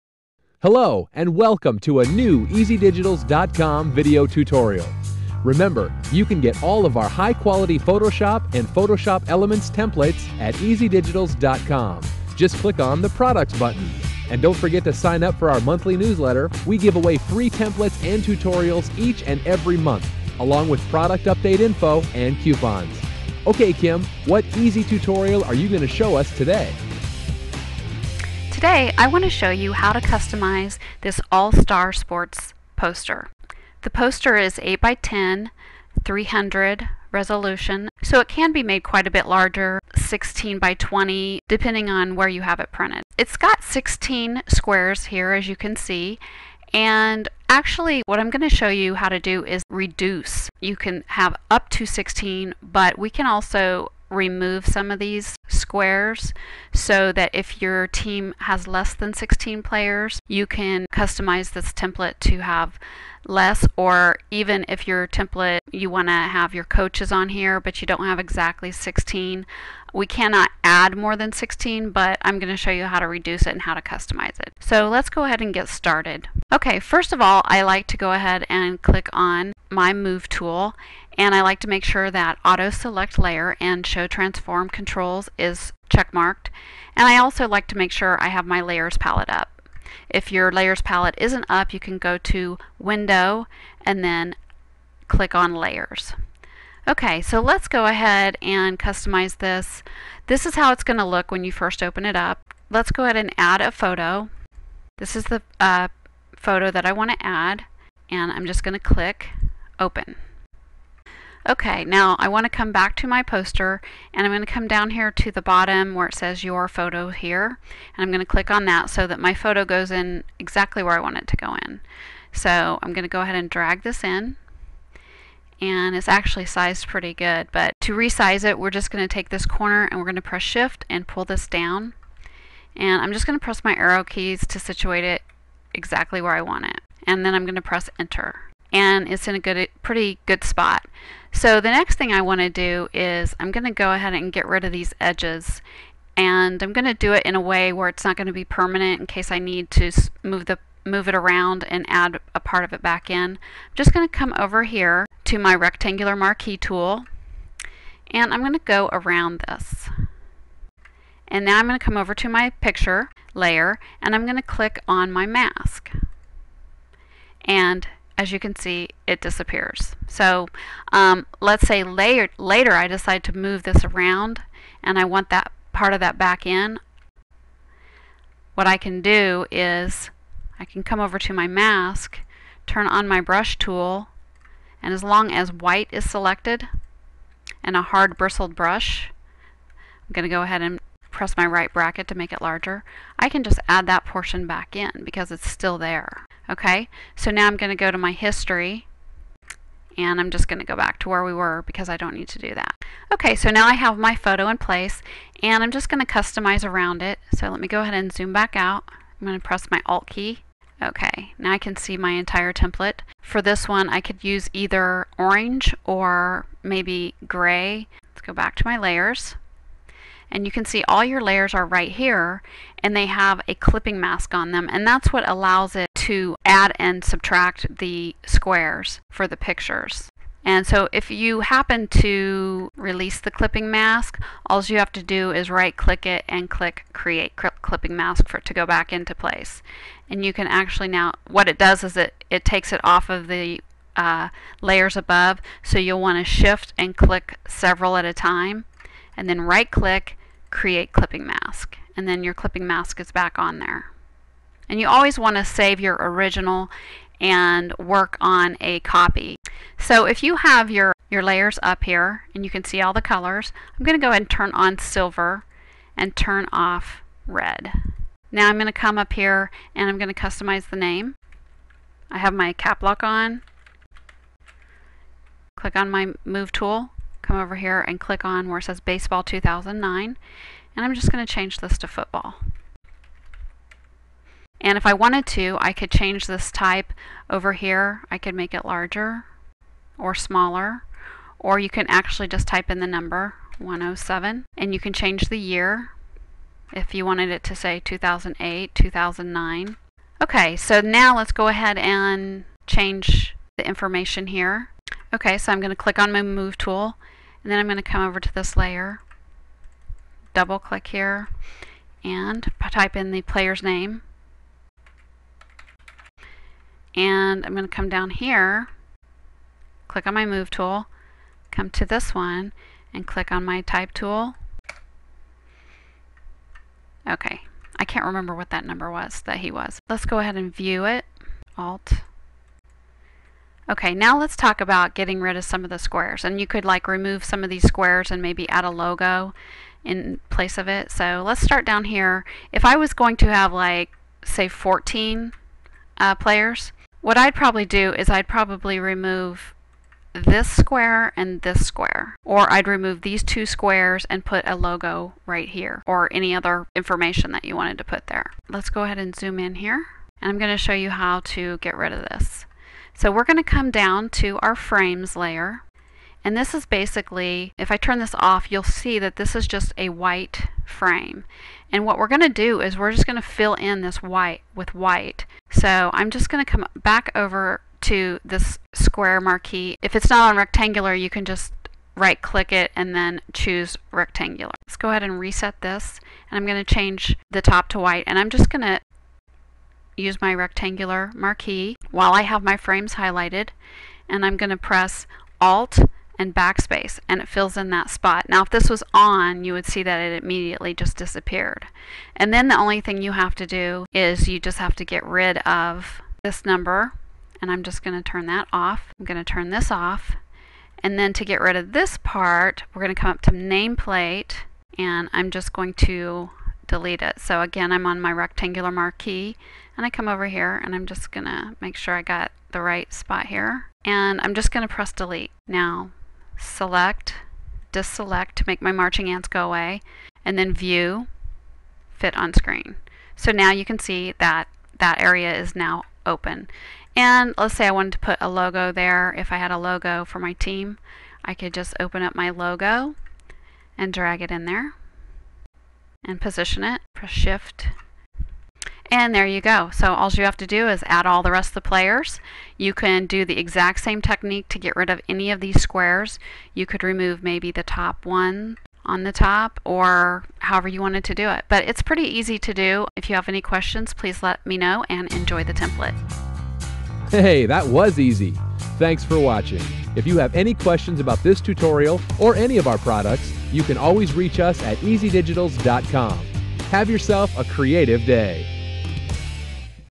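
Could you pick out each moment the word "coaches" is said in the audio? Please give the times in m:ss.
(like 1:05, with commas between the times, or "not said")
1:06.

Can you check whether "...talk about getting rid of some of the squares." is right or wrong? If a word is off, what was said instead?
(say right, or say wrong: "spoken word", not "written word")
right.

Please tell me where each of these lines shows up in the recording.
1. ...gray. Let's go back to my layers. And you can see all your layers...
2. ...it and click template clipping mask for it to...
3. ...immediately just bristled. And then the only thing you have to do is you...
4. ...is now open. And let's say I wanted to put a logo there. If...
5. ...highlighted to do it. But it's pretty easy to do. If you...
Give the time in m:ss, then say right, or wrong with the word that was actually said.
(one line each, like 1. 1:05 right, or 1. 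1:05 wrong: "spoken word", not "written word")
1. 3:37 right
2. 3:56 wrong: "create", not "template"
3. 6:40 wrong: "disappeared", not "bristled"
4. 7:15 right
5. 7:40 wrong: "wanted", not "highlighted".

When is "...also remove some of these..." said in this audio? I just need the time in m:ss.
0:53.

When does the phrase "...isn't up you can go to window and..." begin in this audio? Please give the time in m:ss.
1:31.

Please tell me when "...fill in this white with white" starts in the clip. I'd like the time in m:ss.
6:13.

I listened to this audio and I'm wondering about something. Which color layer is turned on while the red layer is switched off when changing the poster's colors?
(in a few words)
silver.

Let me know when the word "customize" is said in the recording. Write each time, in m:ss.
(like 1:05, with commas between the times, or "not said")
0:29, 1:00, 1:13, 1:38, 3:26, 4:30.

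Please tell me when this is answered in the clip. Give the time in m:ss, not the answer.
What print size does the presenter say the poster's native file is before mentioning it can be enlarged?
0:34.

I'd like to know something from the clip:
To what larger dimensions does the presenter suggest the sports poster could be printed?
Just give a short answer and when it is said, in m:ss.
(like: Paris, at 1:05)
16 by 20, at 0:39.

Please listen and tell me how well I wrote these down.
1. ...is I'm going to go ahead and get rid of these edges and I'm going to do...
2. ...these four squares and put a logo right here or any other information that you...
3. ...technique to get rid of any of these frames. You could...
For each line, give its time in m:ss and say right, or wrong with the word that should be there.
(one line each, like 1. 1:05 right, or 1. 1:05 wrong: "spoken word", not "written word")
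1. 2:22 right
2. 5:53 wrong: "two", not "four"
3. 7:34 wrong: "squares", not "frames".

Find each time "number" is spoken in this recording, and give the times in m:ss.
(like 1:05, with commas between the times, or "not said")
4:52, 5:28, 6:46.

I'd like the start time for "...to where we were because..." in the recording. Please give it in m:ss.
3:20.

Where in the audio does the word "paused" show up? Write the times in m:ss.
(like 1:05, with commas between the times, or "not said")
not said.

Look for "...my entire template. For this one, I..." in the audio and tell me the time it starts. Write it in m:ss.
3:31.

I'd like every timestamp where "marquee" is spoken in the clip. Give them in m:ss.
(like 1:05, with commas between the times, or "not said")
2:36, 6:19, 6:31, 6:58.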